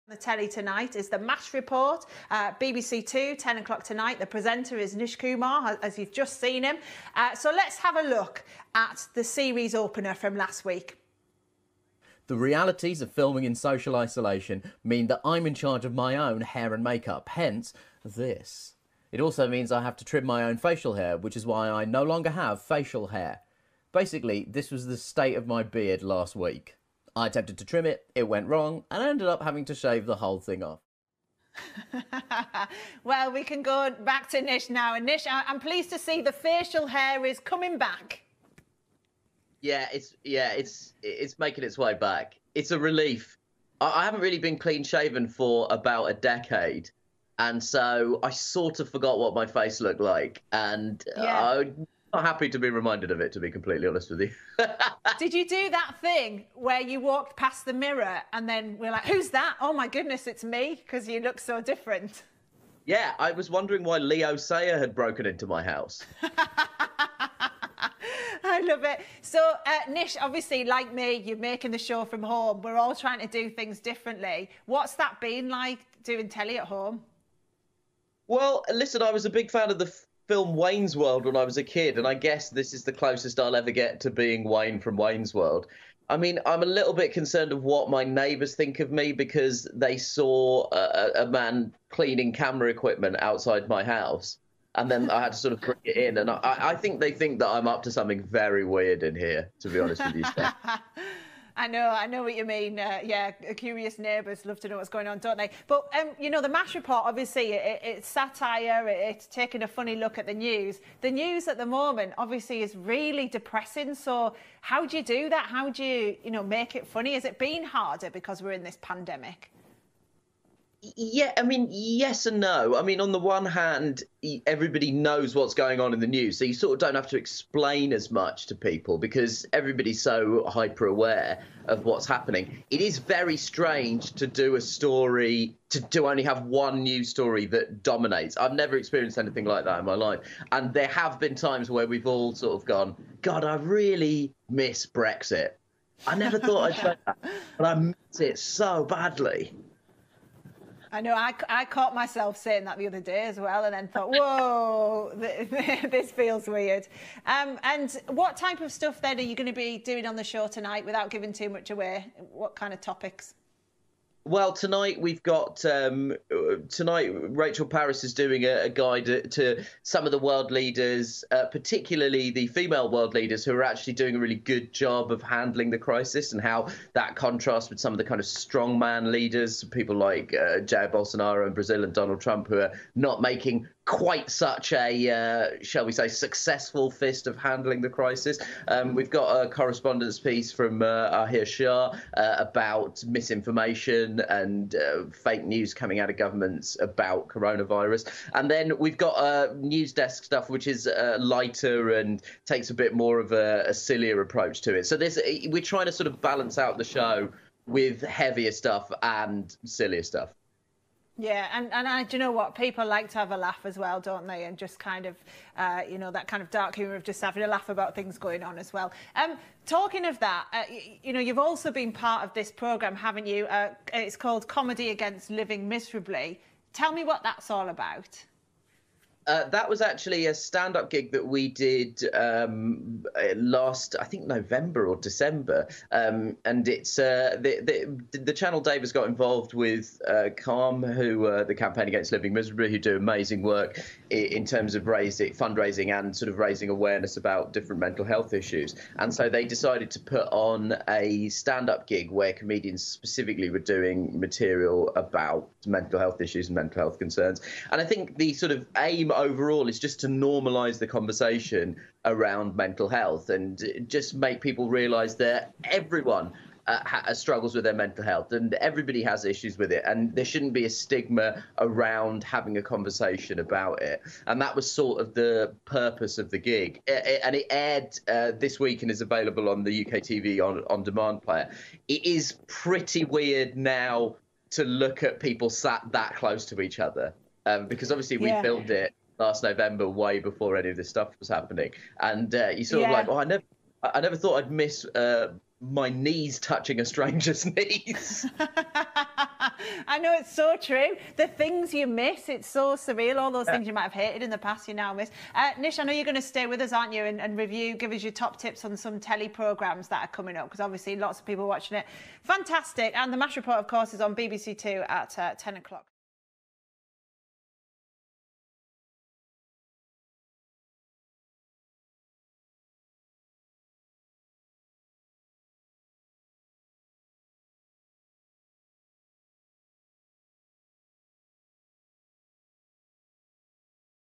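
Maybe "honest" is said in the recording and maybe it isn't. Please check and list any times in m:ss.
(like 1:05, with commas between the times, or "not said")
0:53, 1:39.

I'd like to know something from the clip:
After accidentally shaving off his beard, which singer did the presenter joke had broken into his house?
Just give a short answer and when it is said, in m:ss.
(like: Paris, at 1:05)
Leo Sayer, at 1:03.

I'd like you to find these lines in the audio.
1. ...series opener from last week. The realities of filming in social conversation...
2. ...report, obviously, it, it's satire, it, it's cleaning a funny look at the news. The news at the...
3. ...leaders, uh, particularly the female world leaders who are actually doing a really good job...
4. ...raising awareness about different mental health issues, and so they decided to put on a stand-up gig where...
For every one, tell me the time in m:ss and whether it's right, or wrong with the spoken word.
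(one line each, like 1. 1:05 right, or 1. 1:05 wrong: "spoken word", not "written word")
1. 0:09 wrong: "isolation", not "conversation"
2. 1:46 wrong: "taking", not "cleaning"
3. 2:50 right
4. 4:06 right.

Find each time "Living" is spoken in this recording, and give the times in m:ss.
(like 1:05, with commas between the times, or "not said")
3:45, 4:02.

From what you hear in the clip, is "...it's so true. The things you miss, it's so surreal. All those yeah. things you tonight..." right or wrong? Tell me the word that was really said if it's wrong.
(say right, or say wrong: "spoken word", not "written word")
wrong: "might", not "tonight".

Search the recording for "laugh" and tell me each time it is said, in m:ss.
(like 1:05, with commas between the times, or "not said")
3:33, 3:37.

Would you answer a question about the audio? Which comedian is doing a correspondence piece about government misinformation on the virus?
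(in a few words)
Ahir Shah.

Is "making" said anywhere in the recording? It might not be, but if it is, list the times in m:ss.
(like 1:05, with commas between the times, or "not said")
0:41, 1:11, 3:03.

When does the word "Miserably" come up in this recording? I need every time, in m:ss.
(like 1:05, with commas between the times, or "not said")
3:45, 4:02.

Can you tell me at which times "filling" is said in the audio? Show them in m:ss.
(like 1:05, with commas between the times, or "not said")
not said.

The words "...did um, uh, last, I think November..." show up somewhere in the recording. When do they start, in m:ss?
3:51.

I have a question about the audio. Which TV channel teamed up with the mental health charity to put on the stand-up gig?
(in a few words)
Dave.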